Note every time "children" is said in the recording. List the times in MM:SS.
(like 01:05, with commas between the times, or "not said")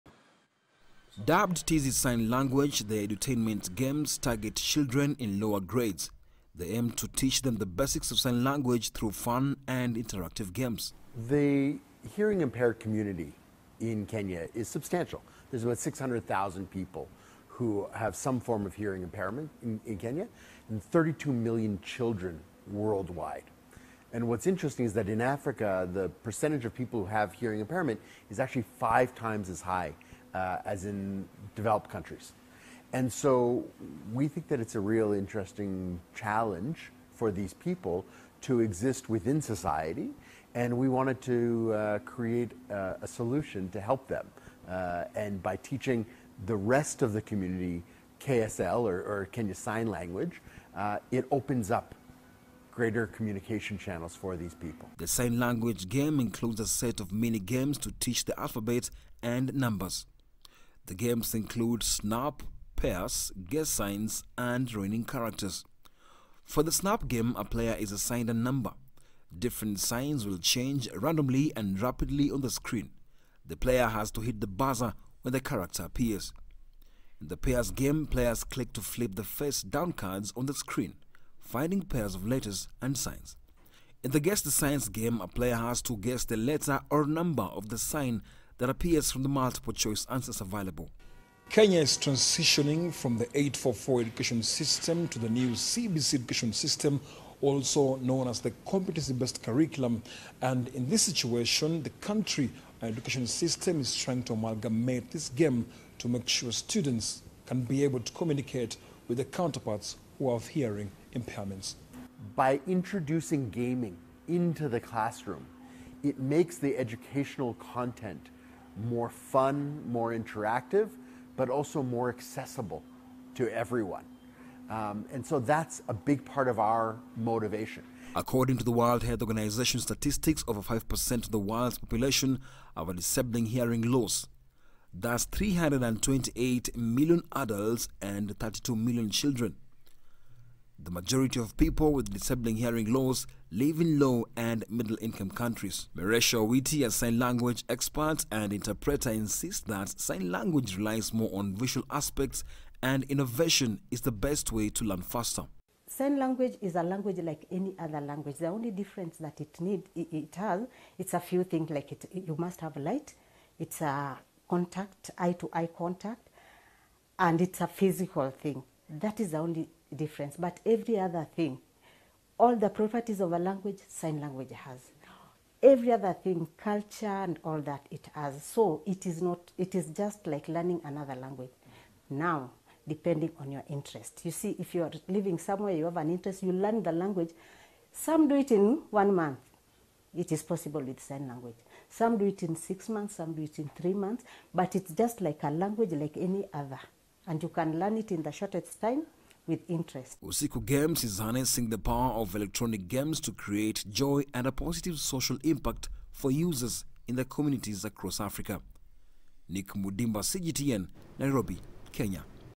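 00:04, 00:21, 02:19.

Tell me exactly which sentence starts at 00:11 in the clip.
The hearing impaired community in Kenya is substantial.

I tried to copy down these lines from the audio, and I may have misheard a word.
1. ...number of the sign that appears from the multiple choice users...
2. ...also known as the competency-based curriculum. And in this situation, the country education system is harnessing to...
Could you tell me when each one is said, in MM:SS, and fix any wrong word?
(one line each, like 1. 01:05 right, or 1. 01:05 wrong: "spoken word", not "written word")
1. 01:27 wrong: "answers", not "users"
2. 01:37 wrong: "trying", not "harnessing".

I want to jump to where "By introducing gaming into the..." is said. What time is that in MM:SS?
01:52.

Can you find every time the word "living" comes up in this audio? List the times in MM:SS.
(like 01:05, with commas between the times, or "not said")
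02:23, 03:05.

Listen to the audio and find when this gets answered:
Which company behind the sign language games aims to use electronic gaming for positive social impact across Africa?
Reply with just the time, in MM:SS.
03:20.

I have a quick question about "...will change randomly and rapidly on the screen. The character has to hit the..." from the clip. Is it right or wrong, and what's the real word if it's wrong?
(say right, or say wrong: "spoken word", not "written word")
wrong: "player", not "character".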